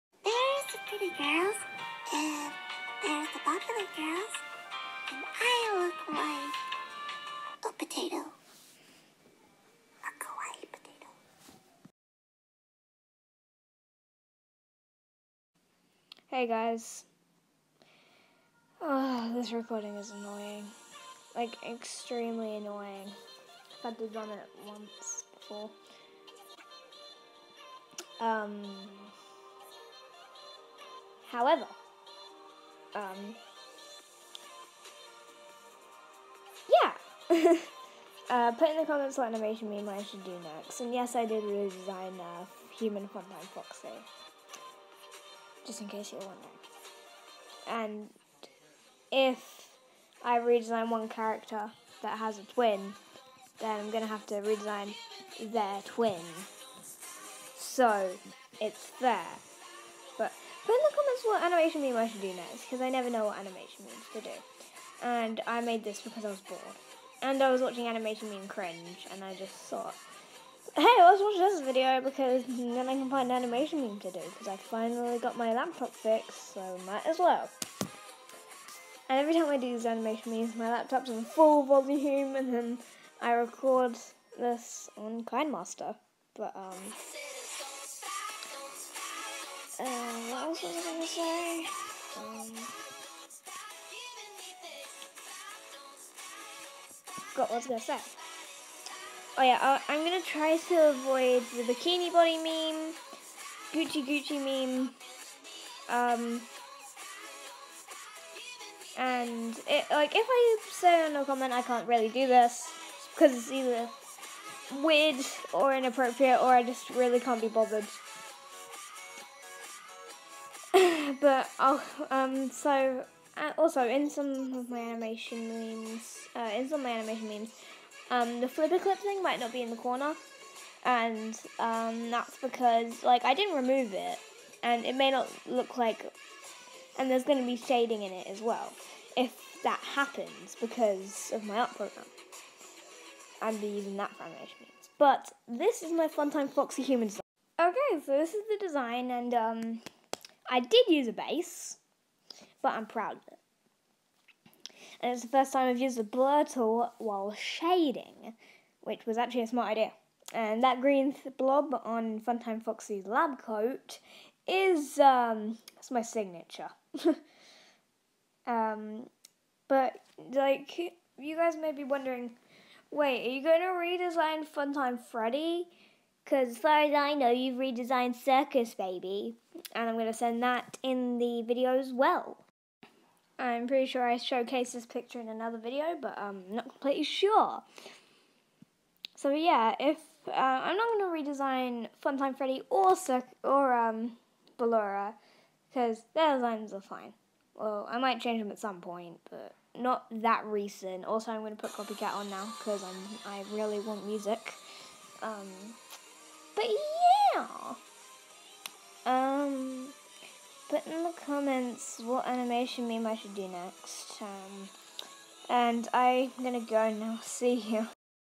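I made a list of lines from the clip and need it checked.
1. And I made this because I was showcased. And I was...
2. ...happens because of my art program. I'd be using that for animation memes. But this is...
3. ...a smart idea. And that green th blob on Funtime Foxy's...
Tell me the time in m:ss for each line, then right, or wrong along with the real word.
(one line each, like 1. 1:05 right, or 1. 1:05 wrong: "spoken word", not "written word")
1. 1:05 wrong: "bored", not "showcased"
2. 2:19 right
3. 2:39 right.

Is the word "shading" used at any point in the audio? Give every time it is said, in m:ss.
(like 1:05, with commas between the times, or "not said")
2:17, 2:37.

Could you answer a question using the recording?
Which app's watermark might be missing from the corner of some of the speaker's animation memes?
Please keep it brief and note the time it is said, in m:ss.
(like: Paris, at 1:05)
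FlipaClip, at 2:08.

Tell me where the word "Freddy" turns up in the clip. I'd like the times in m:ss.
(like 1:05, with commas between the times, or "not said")
2:54, 3:12.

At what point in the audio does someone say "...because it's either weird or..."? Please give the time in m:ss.
1:53.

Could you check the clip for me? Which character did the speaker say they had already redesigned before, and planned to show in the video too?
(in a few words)
Circus Baby.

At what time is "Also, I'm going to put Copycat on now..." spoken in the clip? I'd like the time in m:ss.
3:21.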